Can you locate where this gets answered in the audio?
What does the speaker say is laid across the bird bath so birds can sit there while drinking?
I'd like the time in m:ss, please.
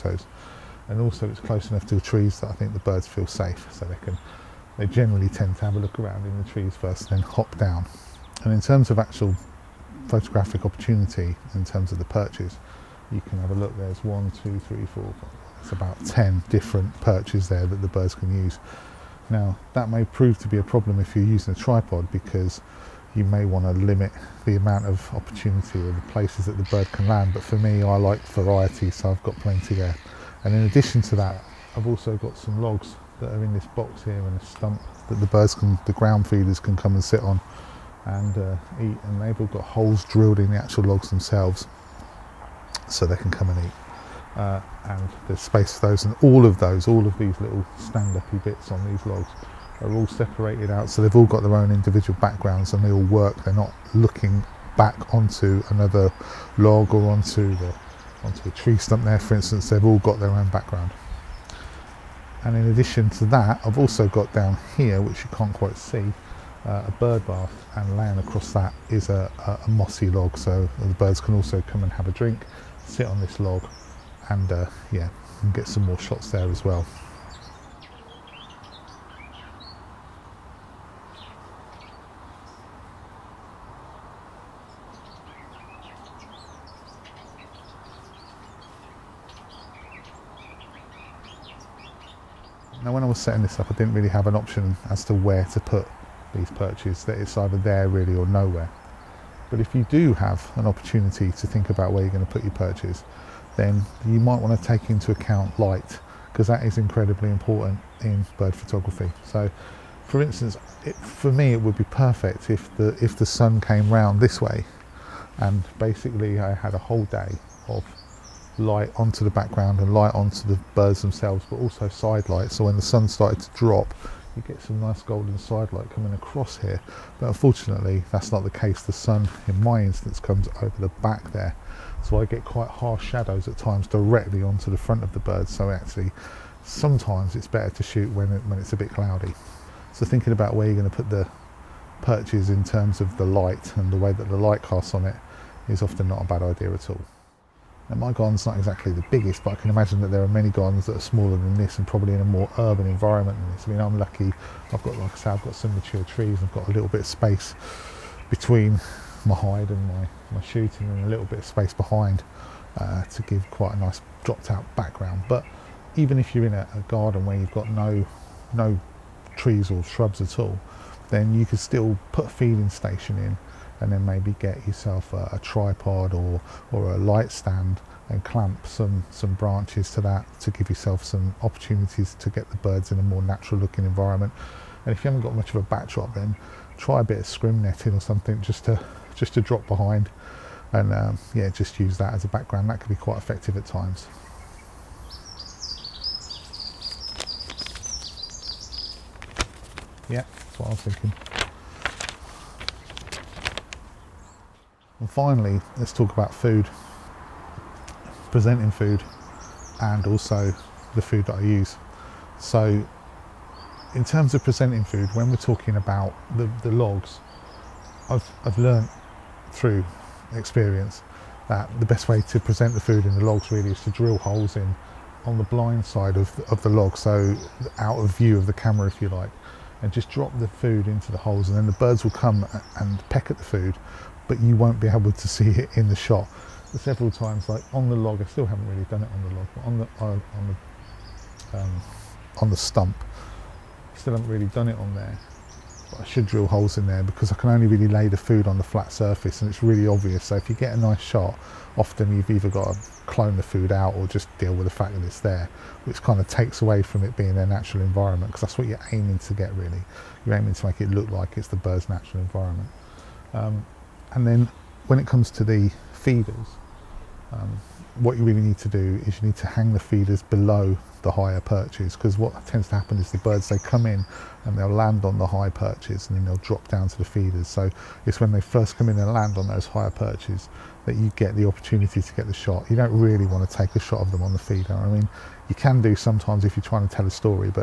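1:09.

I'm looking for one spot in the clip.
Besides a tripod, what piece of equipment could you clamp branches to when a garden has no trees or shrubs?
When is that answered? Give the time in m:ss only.
2:56.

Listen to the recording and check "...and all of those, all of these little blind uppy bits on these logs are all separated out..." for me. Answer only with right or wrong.
wrong.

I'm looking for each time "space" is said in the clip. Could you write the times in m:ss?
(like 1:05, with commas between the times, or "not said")
0:45, 2:37, 2:41.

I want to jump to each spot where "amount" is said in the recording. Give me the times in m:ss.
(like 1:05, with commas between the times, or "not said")
0:24.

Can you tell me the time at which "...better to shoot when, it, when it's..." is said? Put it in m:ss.
2:17.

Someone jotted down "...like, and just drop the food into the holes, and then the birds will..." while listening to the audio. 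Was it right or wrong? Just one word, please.
right.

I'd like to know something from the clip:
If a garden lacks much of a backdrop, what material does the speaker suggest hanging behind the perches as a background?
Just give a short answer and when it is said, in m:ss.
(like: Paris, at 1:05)
scrim netting, at 3:07.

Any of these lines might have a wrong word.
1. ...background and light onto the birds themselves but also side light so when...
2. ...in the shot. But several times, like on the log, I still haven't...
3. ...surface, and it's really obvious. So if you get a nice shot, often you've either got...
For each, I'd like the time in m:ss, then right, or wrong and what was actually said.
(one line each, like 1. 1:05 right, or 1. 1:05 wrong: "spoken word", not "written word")
1. 1:59 right
2. 3:55 right
3. 4:08 right.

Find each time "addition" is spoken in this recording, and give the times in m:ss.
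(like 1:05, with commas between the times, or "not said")
0:30, 1:02.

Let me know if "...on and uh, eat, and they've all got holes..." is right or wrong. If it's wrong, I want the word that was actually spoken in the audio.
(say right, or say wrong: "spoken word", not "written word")
right.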